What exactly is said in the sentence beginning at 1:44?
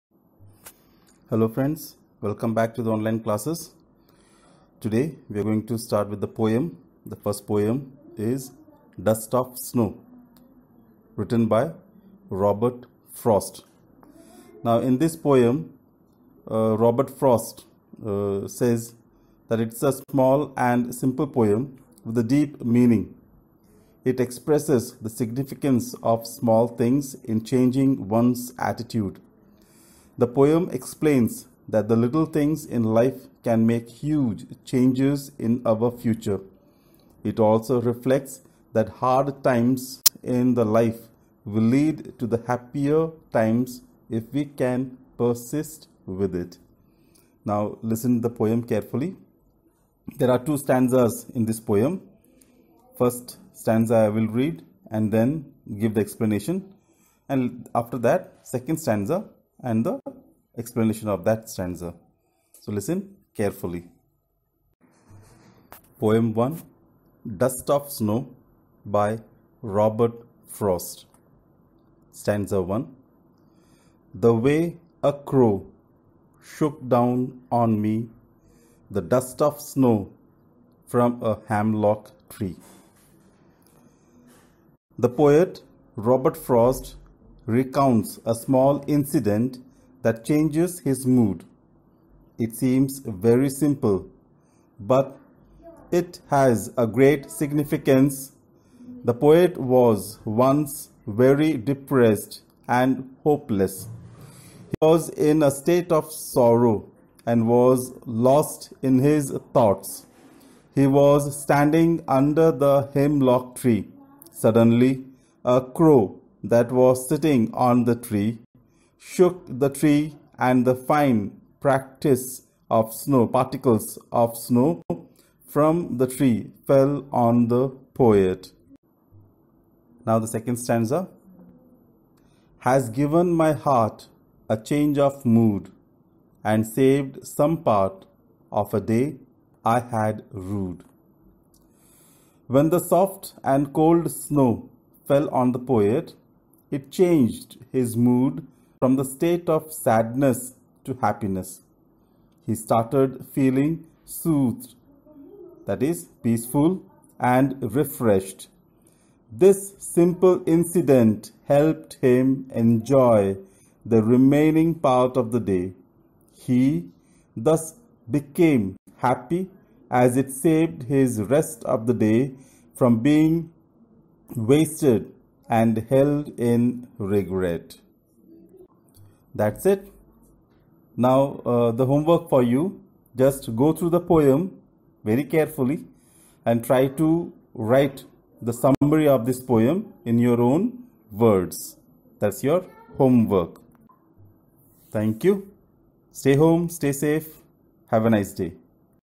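He was in a state of sorrow and was lost in his thoughts.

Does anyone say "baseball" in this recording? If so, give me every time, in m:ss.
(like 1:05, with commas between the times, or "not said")
not said.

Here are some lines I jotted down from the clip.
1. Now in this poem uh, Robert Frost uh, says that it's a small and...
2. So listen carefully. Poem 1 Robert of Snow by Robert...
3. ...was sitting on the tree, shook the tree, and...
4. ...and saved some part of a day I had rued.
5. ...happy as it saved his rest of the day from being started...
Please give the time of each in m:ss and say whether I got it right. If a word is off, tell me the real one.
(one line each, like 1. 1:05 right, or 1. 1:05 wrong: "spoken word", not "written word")
1. 0:14 right
2. 1:02 wrong: "Dust", not "Robert"
3. 1:56 right
4. 2:16 right
5. 2:48 wrong: "wasted", not "started".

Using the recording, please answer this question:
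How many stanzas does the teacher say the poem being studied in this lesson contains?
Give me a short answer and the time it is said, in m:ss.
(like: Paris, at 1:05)
2, at 0:50.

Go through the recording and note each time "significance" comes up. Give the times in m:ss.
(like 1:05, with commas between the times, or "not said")
0:25, 1:37.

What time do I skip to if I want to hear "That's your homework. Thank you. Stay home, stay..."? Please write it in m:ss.
3:12.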